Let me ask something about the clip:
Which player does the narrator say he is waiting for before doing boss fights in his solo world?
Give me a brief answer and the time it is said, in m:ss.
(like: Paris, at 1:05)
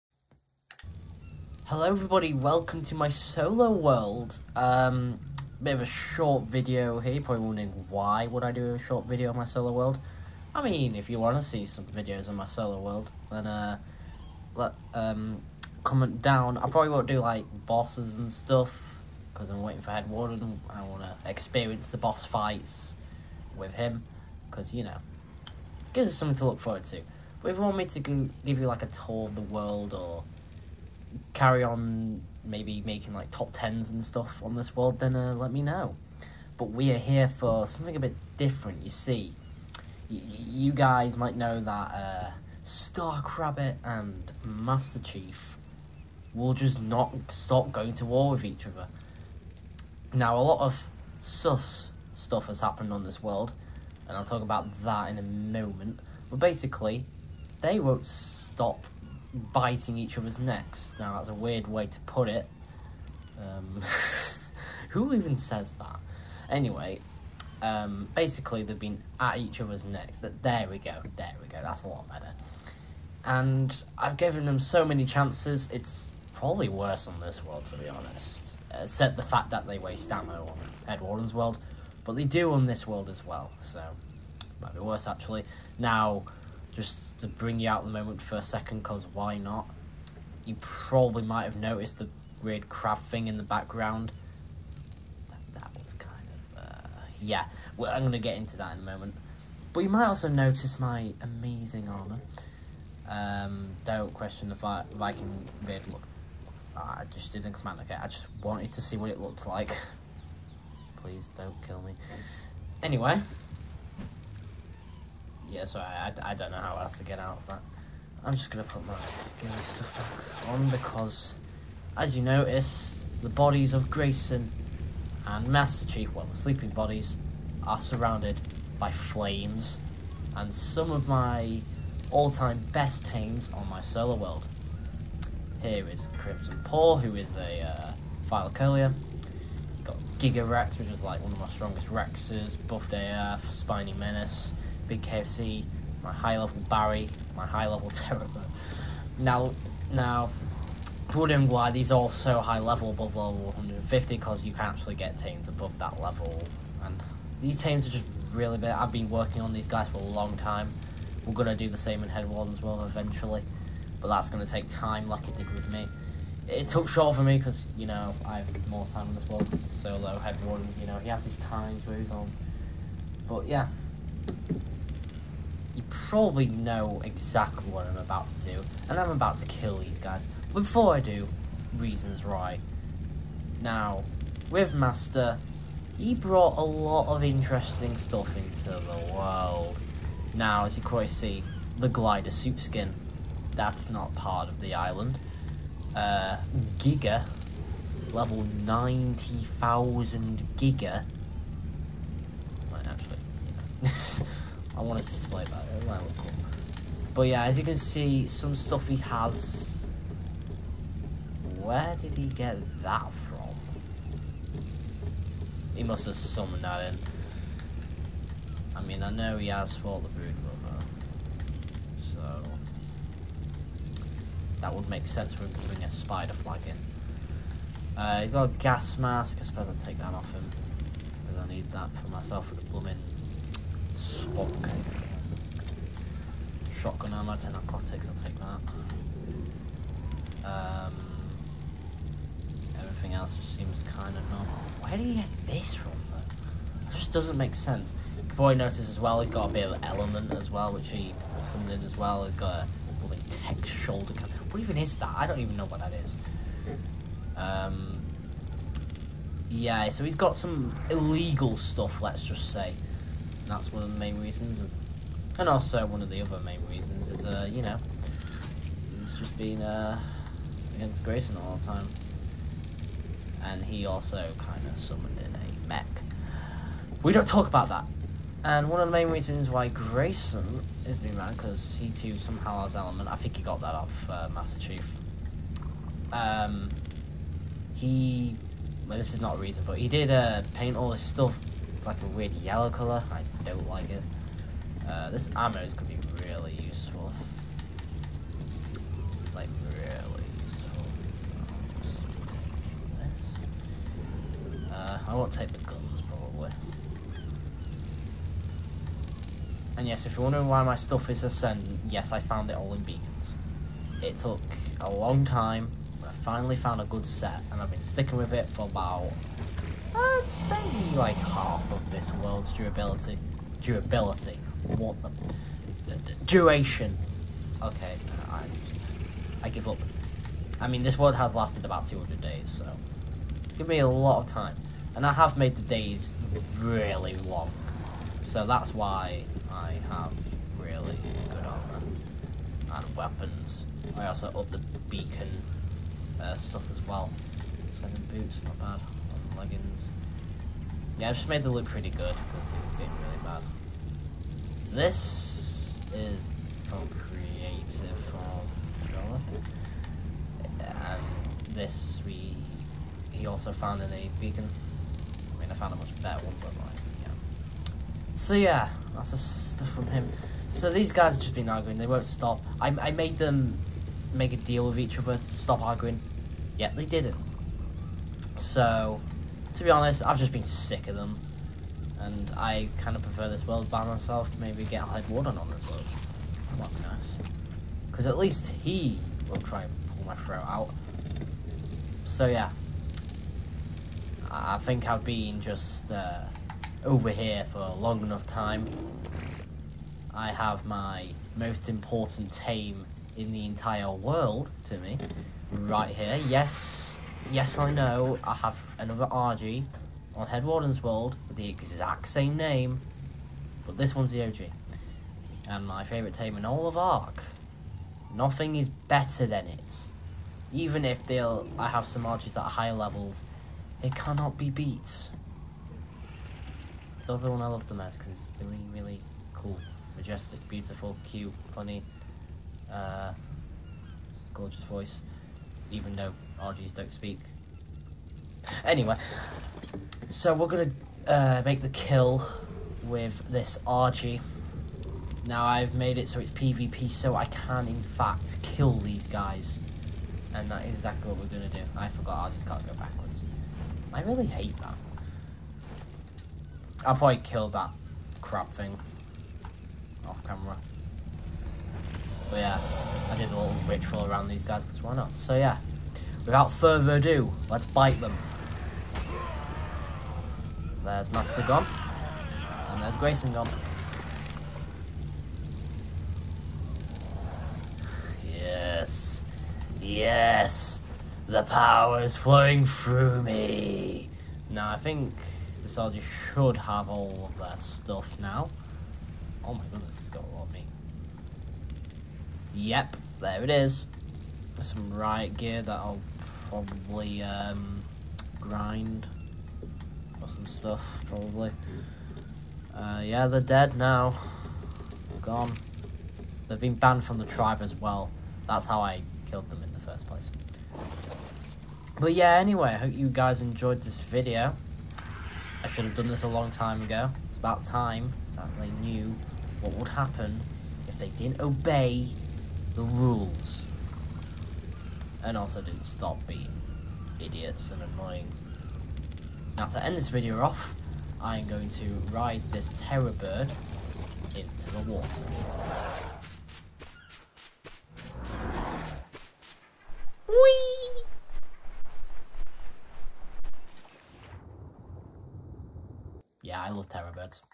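Headwarden, at 0:19.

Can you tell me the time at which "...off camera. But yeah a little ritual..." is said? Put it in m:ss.
7:40.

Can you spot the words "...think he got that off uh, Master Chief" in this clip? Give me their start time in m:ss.
4:43.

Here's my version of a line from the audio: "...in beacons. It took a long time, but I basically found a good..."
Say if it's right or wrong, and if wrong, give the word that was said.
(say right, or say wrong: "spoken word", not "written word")
wrong: "finally", not "basically".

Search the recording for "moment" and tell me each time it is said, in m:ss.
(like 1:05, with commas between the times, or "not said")
0:55, 1:27, 1:38.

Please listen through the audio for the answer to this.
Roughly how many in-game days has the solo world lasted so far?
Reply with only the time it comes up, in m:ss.
5:31.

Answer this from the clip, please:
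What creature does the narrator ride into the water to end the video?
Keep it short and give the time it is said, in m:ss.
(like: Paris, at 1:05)
terror bird, at 8:52.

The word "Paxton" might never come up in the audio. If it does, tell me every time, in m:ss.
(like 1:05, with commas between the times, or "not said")
not said.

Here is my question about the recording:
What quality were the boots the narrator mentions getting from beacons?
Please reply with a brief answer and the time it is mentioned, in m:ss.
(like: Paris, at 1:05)
Seven, at 5:47.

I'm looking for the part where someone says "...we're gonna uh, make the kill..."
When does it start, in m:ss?
7:20.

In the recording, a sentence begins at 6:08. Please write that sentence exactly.
So yeah, that's the stuff from him.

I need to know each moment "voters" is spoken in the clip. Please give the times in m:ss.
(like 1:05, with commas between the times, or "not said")
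not said.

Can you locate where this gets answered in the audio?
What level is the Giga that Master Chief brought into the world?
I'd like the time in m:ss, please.
3:18.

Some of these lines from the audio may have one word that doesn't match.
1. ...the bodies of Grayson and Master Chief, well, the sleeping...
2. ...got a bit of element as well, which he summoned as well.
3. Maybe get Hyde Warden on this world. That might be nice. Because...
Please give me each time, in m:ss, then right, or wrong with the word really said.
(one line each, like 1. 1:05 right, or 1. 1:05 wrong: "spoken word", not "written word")
1. 2:03 right
2. 4:09 right
3. 6:24 right.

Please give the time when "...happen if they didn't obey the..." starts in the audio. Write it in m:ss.
8:39.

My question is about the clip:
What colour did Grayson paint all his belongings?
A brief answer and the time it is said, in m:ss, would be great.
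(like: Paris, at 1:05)
yellow, at 4:52.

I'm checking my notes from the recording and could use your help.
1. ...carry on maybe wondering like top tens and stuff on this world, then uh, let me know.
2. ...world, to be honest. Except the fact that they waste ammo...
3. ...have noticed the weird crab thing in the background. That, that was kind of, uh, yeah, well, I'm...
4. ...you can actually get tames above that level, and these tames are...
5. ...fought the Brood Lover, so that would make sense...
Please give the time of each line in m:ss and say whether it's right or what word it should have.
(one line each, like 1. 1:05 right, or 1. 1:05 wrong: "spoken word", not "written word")
1. 0:31 wrong: "making", not "wondering"
2. 1:17 right
3. 1:31 right
4. 2:34 right
5. 3:39 right.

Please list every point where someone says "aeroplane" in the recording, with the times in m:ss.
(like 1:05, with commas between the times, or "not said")
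not said.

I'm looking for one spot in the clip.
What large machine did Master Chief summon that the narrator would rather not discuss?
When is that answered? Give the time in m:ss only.
4:35.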